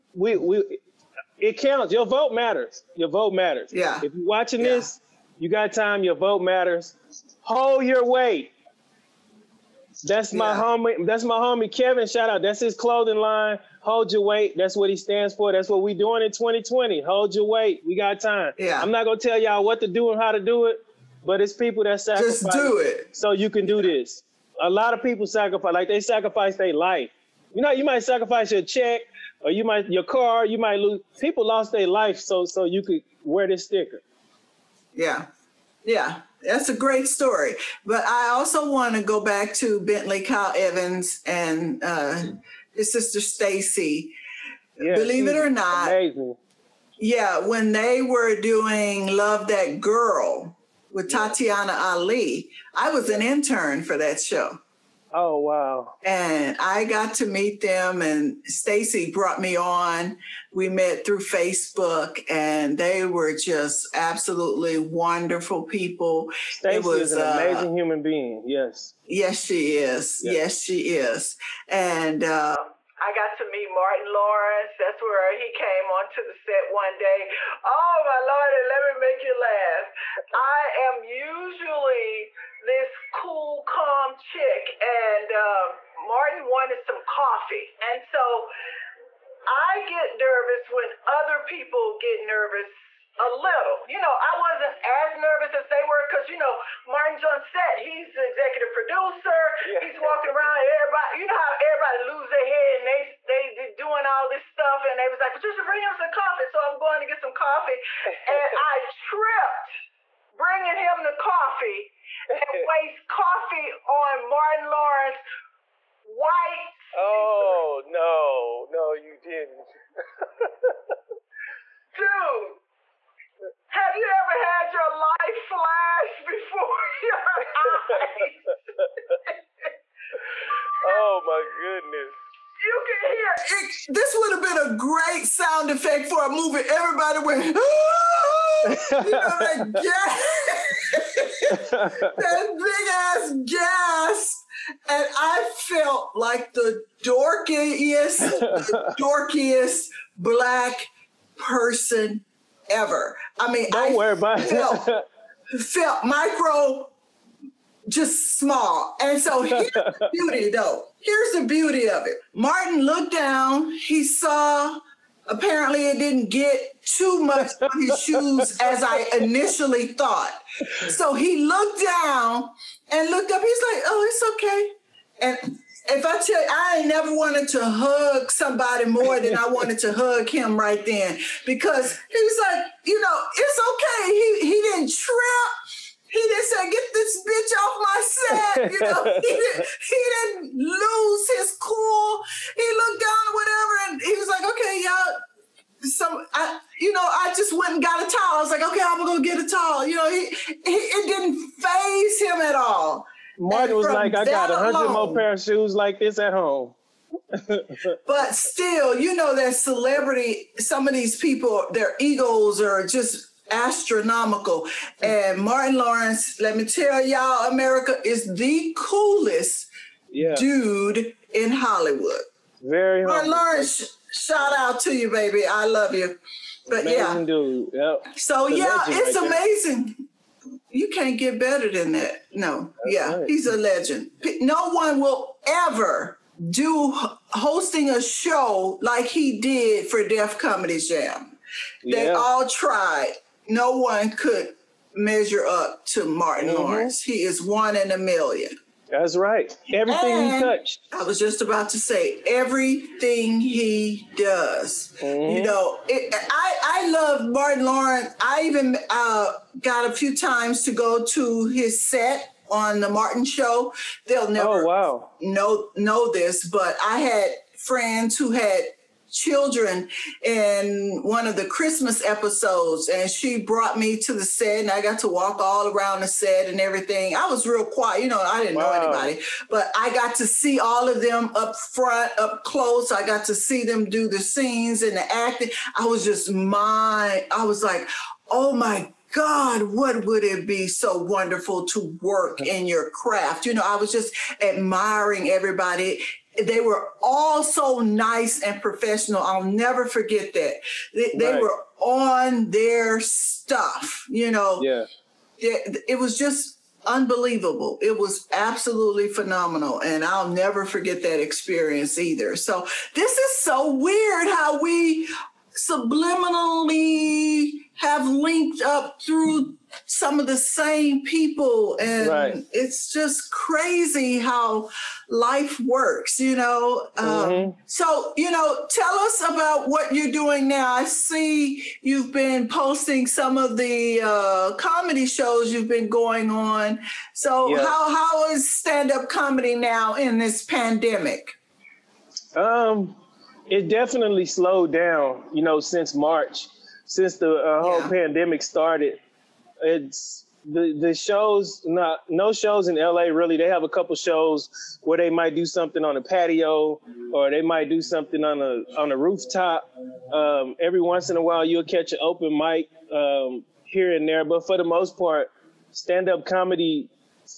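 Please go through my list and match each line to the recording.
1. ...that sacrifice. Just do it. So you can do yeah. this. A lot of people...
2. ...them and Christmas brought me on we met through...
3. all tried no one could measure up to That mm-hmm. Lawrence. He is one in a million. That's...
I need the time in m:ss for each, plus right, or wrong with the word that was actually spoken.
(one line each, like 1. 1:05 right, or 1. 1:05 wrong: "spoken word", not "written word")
1. 0:21 right
2. 0:57 wrong: "Stacy", not "Christmas"
3. 4:02 wrong: "Martin", not "That".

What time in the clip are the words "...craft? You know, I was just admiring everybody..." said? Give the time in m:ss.
4:52.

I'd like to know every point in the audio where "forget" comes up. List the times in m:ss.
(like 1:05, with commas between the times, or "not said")
4:59, 5:10.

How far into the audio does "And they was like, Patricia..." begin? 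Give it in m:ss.
1:44.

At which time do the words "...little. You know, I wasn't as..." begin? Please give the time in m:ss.
1:33.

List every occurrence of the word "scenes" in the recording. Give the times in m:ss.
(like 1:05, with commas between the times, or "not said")
4:44.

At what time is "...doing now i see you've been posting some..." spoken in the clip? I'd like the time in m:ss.
5:30.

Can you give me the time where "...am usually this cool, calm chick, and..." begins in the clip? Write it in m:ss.
1:20.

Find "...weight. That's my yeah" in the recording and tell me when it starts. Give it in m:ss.
0:08.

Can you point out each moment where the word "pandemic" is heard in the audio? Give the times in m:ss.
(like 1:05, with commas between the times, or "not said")
5:40, 5:48.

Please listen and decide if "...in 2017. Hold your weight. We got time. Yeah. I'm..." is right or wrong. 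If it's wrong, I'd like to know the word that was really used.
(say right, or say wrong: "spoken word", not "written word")
wrong: "2020", not "2017".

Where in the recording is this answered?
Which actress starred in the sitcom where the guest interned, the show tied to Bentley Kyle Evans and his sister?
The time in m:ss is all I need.
0:51.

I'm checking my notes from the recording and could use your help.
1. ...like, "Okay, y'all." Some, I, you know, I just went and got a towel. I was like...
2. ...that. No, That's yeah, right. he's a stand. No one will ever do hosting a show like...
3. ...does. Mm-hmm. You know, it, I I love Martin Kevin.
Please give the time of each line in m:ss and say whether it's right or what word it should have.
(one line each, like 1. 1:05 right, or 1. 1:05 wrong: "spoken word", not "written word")
1. 3:14 right
2. 3:51 wrong: "legend", not "stand"
3. 4:14 wrong: "Lawrence", not "Kevin".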